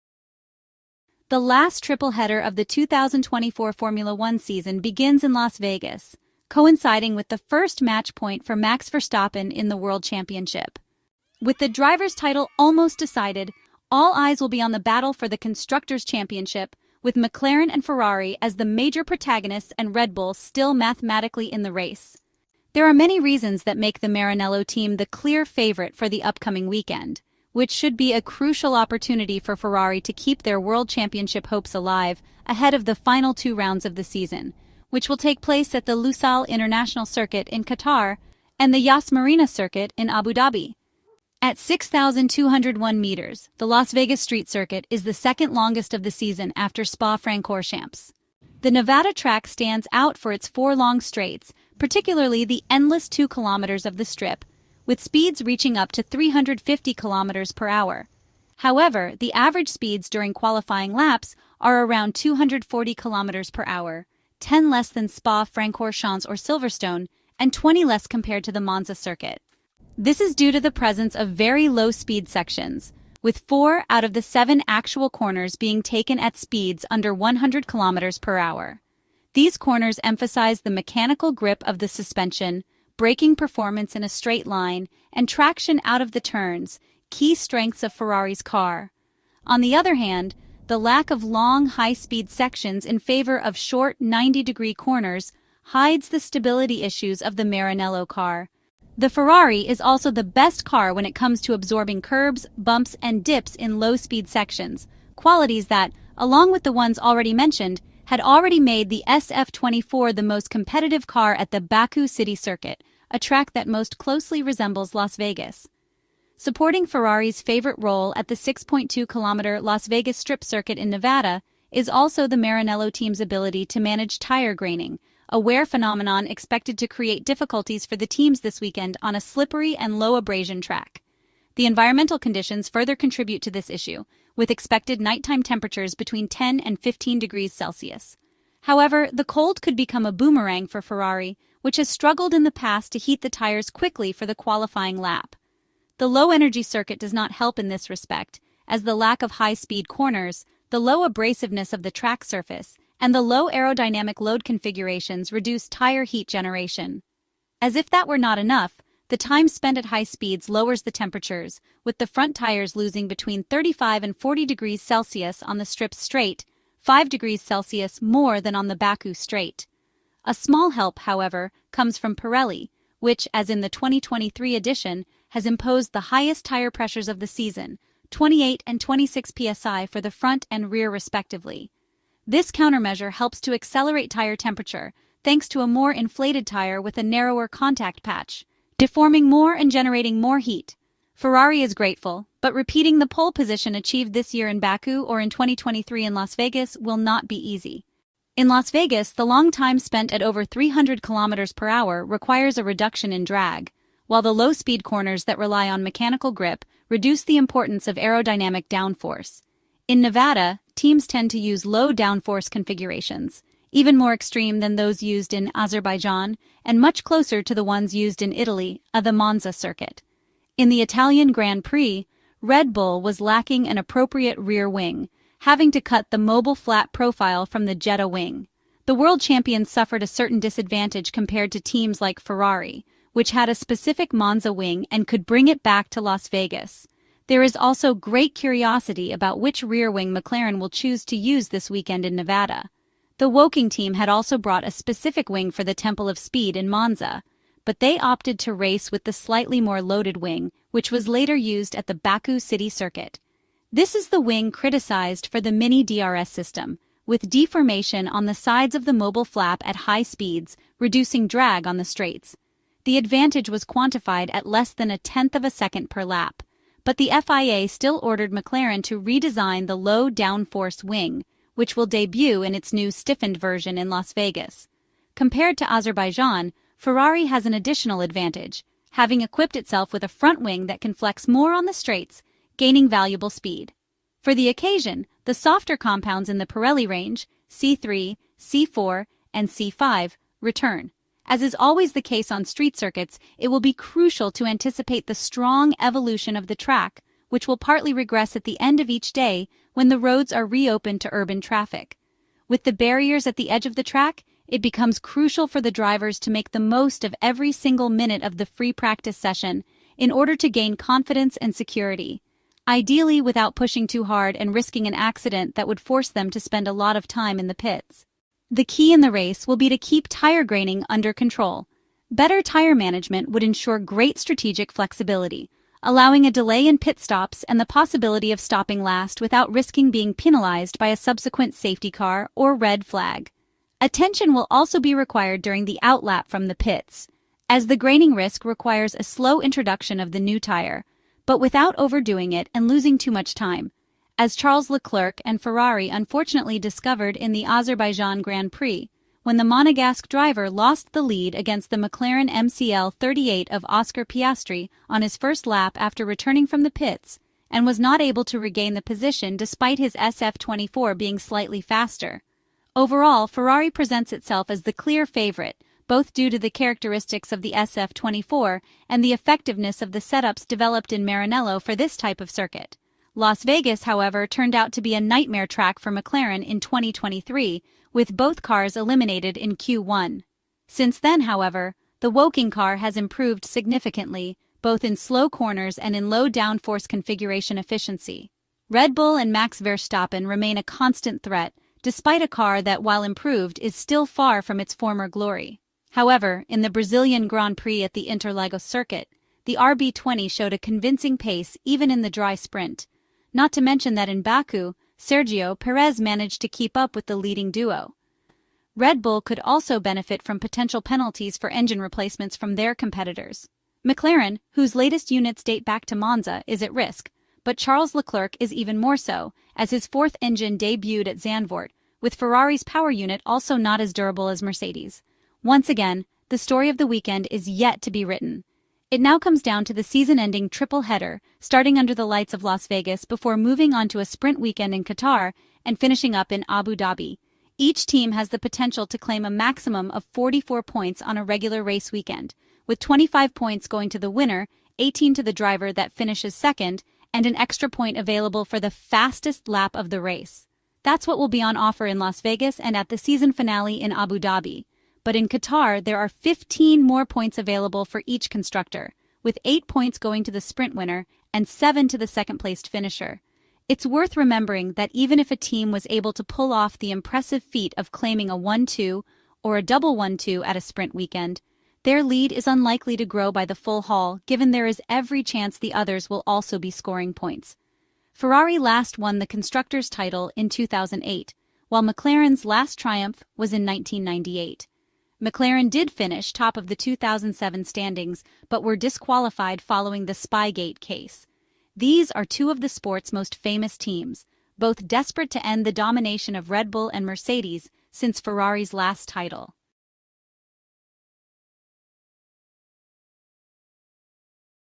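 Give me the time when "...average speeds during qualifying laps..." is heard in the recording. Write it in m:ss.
0:59.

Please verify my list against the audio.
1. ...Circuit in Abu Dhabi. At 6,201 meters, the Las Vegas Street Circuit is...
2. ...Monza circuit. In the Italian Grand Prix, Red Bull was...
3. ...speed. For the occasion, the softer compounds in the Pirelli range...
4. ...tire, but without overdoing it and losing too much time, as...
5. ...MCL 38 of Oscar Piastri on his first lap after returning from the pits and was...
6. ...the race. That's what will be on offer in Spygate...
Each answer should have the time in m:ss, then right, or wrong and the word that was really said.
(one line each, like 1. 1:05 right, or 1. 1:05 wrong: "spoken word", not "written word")
1. 0:39 right
2. 3:39 right
3. 4:43 right
4. 5:40 right
5. 5:52 right
6. 7:29 wrong: "Las", not "Spygate".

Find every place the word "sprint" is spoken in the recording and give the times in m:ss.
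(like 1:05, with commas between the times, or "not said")
6:42, 7:14, 7:40, 7:50.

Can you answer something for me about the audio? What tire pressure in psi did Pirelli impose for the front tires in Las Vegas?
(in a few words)
28.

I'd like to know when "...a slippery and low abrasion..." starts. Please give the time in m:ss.
2:09.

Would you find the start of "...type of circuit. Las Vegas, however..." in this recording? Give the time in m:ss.
6:11.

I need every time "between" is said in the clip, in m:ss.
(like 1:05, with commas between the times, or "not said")
2:15, 2:43.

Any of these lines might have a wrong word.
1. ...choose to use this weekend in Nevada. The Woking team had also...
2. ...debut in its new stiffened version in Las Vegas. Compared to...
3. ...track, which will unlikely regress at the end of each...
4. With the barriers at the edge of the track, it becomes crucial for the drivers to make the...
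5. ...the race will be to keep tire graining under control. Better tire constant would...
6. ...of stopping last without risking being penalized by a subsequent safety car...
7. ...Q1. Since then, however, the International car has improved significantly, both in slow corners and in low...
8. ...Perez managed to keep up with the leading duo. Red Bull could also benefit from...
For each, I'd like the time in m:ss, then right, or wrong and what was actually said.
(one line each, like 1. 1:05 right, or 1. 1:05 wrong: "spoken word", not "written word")
1. 4:00 right
2. 4:31 right
3. 4:56 wrong: "partly", not "unlikely"
4. 5:02 right
5. 5:18 wrong: "management", not "constant"
6. 5:28 right
7. 6:19 wrong: "Woking", not "International"
8. 6:45 right.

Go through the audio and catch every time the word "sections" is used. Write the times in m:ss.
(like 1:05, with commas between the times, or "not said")
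1:12, 1:32, 1:44.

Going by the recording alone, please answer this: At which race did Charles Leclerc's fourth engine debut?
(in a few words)
Zandvoort.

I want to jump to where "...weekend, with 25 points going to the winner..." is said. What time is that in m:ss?
7:21.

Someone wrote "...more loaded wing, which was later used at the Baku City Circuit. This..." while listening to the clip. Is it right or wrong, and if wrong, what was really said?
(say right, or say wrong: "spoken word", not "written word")
right.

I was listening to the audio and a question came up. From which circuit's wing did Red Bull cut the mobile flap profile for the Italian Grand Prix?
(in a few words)
Jeddah.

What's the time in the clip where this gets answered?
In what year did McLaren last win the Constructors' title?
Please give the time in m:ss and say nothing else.
8:03.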